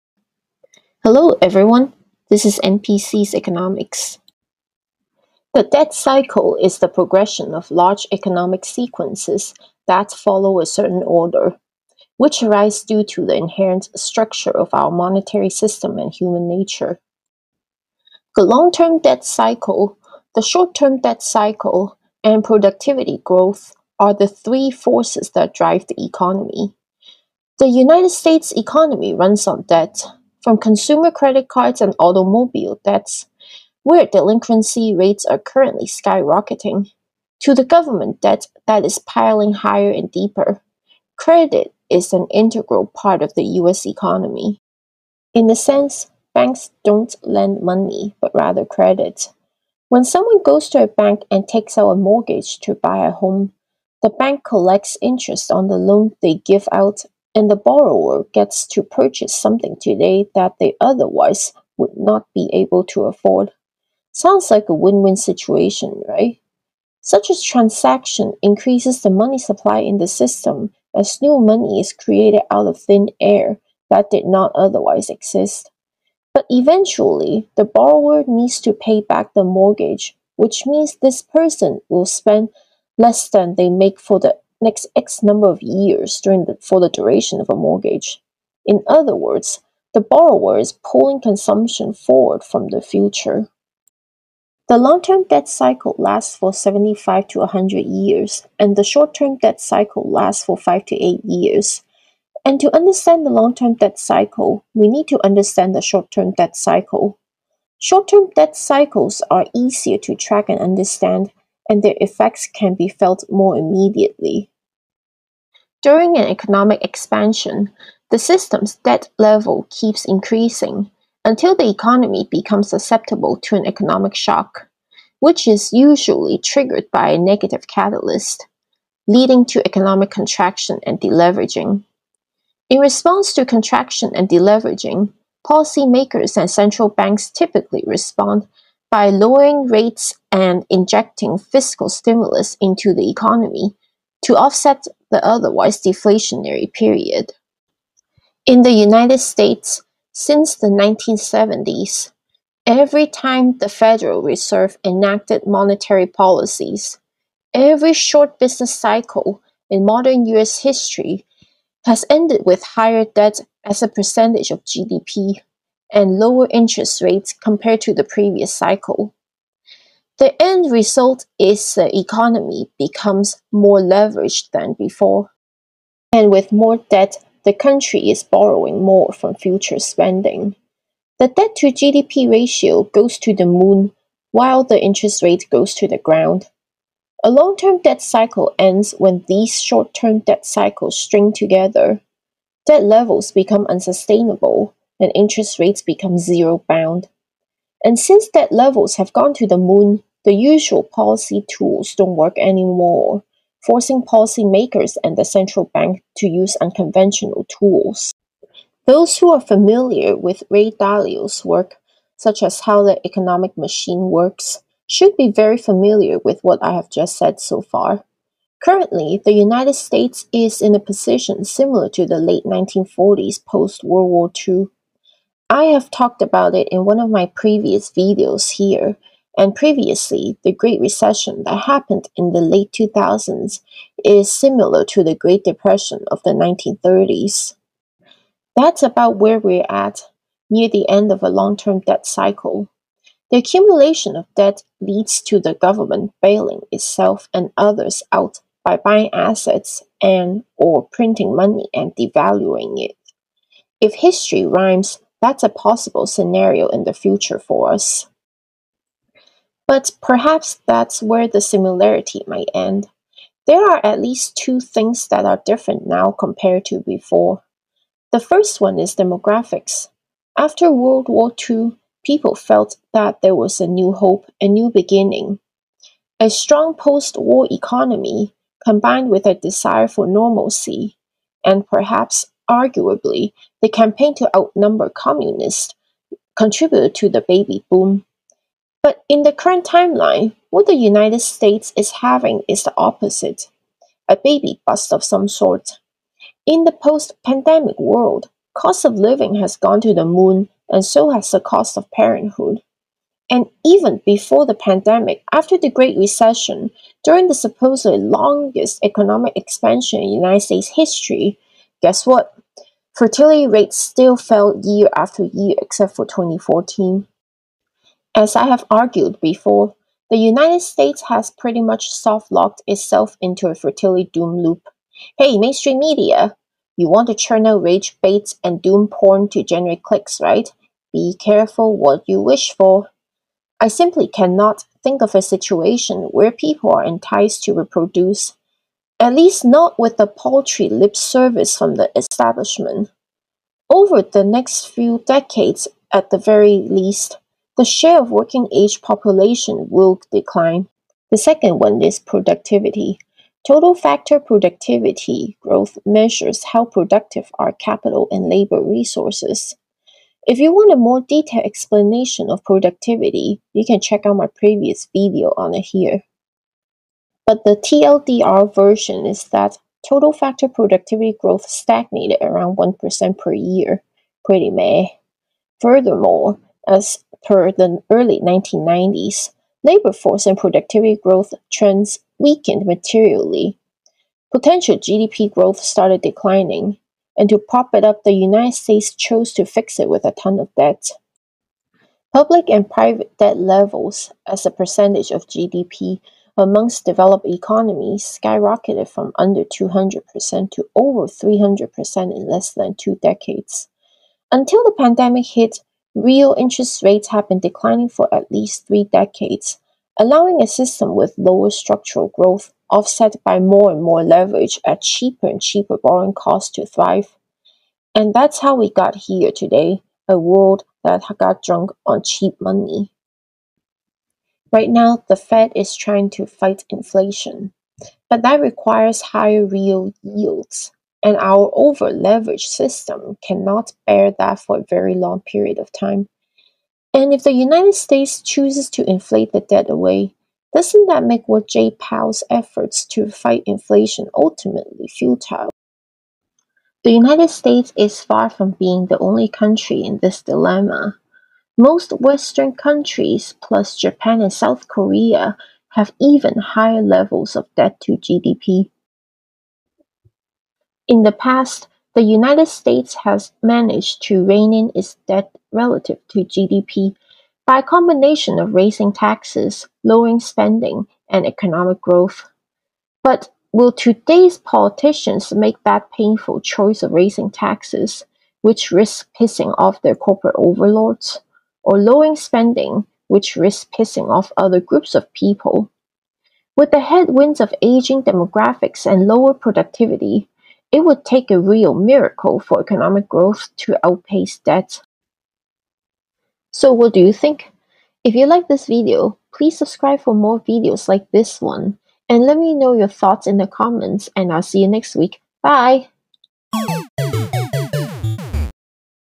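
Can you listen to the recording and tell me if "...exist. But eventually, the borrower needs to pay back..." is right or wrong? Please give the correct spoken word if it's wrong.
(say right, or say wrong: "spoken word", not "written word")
right.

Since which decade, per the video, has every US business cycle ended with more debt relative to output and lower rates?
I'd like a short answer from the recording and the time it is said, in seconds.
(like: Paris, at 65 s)
1970s, at 150 s.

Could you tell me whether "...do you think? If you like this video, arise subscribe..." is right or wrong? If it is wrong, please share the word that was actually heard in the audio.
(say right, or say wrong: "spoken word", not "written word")
wrong: "please", not "arise".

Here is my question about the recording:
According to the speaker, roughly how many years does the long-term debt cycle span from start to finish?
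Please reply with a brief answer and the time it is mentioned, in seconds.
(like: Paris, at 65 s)
75 to 100 years, at 96 s.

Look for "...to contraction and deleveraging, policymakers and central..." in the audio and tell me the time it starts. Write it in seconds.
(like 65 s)
133 s.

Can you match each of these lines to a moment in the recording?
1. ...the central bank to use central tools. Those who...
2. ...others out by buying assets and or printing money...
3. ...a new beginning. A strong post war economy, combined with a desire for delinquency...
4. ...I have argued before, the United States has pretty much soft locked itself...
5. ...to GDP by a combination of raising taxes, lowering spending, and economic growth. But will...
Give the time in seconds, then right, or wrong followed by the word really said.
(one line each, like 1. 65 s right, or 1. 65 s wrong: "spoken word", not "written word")
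1. 205 s wrong: "unconventional", not "central"
2. 247 s right
3. 274 s wrong: "normalcy", not "delinquency"
4. 318 s right
5. 466 s right.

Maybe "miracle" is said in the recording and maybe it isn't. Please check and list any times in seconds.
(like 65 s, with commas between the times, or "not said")
491 s.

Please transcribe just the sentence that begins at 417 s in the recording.
And that's how we got here today a world that got drunk on cheap money.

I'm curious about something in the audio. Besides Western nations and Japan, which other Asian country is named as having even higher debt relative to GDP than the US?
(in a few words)
South Korea.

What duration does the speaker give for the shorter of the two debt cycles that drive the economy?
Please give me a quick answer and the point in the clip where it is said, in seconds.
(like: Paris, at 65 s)
5 to 8 years, at 100 s.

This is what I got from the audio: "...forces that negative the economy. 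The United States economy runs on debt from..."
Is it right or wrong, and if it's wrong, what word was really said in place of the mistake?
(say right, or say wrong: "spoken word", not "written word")
wrong: "drive", not "negative".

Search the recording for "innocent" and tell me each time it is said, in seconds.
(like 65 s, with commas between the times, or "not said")
not said.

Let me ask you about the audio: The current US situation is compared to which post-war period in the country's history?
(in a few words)
late 1940s.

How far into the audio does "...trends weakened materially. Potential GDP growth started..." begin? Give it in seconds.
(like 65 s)
381 s.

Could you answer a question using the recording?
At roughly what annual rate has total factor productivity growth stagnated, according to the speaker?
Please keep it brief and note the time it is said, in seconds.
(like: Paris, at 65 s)
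1%, at 372 s.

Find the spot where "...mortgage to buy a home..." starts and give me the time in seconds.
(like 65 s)
51 s.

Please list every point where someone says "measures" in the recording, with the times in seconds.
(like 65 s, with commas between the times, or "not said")
355 s.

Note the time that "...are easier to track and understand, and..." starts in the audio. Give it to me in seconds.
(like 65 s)
109 s.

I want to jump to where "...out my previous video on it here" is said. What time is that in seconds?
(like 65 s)
364 s.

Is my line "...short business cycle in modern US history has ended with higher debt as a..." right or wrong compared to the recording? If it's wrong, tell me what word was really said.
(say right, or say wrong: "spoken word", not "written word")
right.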